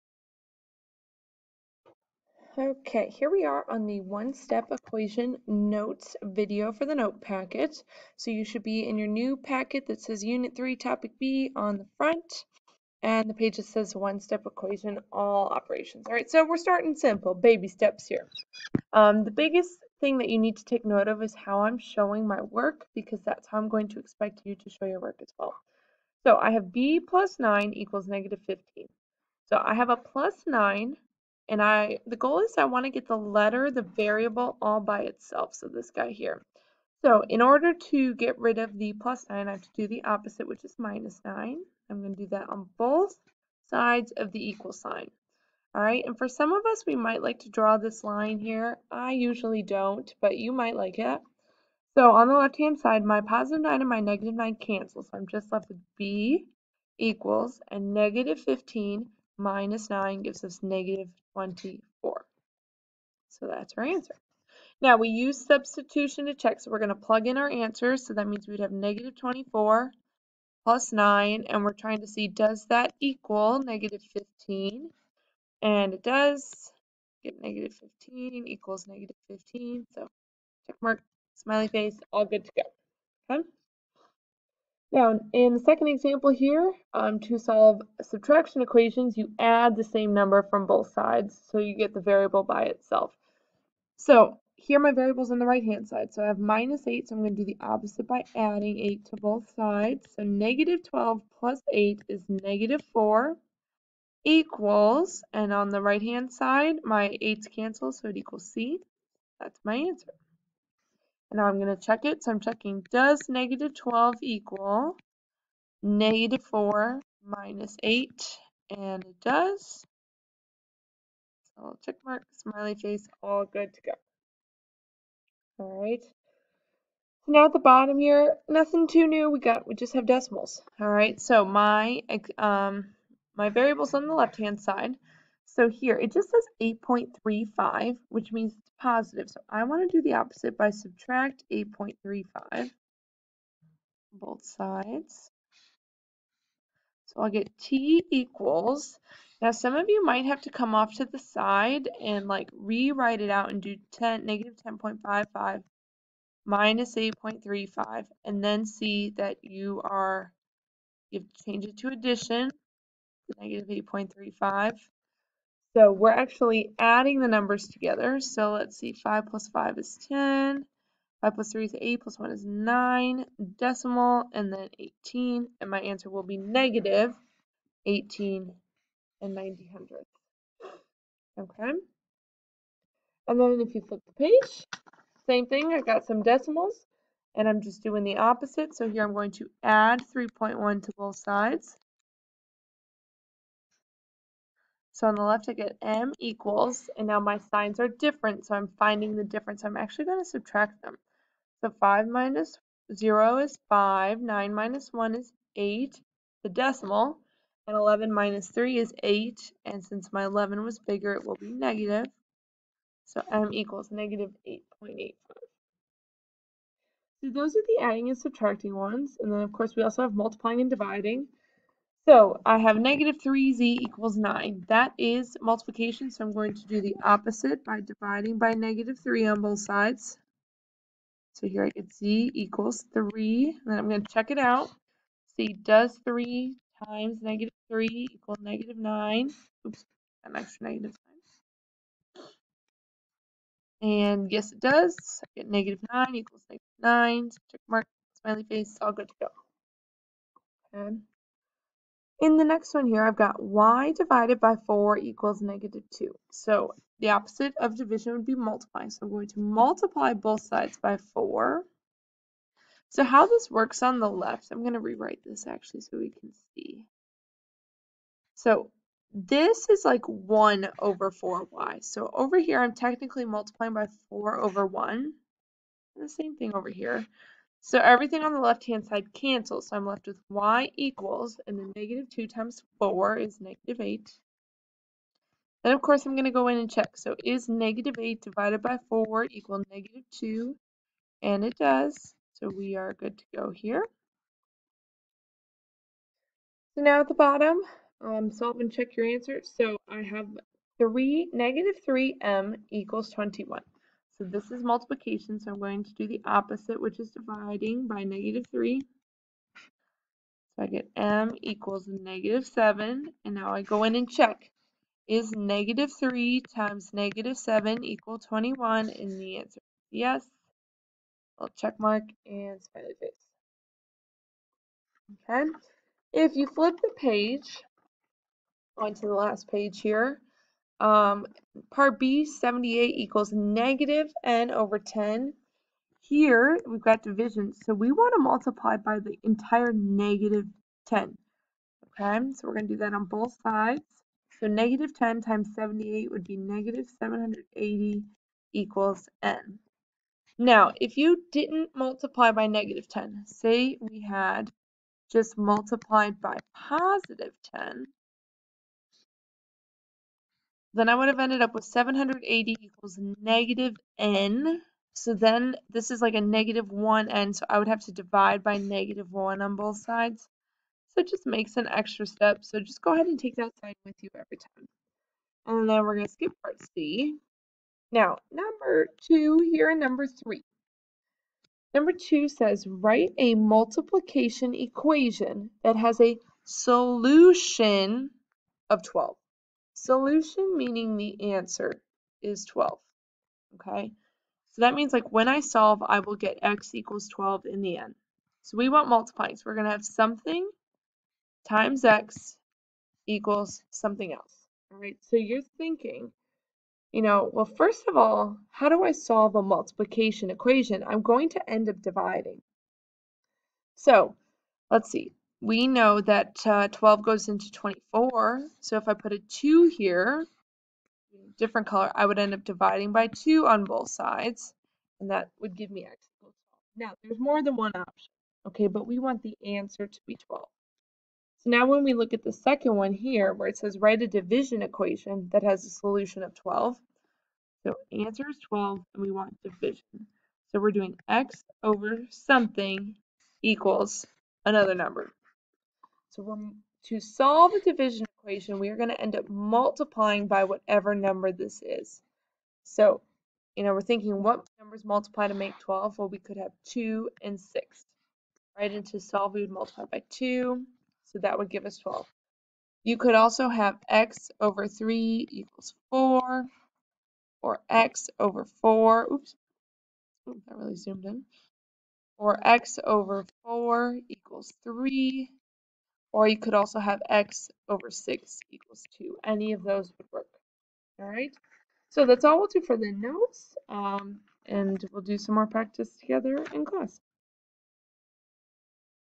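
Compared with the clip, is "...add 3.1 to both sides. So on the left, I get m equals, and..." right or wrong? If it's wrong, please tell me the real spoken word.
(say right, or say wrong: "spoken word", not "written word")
right.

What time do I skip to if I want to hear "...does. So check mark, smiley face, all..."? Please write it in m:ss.
1:59.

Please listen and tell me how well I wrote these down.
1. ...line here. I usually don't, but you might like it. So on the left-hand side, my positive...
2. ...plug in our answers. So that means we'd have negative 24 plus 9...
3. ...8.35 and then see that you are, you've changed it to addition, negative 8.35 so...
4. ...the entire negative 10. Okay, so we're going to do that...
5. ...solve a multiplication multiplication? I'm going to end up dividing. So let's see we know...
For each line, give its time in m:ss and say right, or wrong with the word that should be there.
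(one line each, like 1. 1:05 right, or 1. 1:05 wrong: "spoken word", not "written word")
1. 0:48 right
2. 1:06 right
3. 2:36 right
4. 5:38 right
5. 6:48 wrong: "equation", not "multiplication".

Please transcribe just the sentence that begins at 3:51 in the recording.
So here I get z equals 3, and then I'm going to check it out.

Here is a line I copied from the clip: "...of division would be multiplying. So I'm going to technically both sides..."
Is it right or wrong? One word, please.
wrong.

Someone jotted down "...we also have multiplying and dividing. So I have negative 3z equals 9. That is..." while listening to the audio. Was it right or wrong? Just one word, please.
right.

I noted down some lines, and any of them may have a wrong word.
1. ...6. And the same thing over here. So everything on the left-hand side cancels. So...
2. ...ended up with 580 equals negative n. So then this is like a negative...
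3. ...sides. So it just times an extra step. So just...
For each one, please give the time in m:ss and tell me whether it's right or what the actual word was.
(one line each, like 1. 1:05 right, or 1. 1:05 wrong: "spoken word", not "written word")
1. 4:34 wrong: "1", not "6"
2. 6:01 wrong: "780", not "580"
3. 6:09 wrong: "makes", not "times".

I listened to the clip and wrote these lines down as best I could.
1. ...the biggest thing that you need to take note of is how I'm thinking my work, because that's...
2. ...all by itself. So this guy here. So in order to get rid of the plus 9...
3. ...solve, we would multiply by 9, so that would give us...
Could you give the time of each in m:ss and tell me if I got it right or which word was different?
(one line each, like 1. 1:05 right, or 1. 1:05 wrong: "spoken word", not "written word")
1. 0:19 wrong: "showing", not "thinking"
2. 0:34 right
3. 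7:38 wrong: "2", not "9".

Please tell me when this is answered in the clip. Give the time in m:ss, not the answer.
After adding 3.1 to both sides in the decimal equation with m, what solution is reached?
3:33.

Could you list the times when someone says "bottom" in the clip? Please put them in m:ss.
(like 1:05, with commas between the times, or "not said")
2:07, 4:57.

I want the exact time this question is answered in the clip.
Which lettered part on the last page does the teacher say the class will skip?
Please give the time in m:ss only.
6:16.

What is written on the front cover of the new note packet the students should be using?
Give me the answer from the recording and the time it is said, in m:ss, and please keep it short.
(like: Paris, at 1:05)
Unit 3 Topic B, at 0:10.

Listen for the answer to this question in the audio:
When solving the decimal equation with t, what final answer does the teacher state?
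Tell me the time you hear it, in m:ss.
2:56.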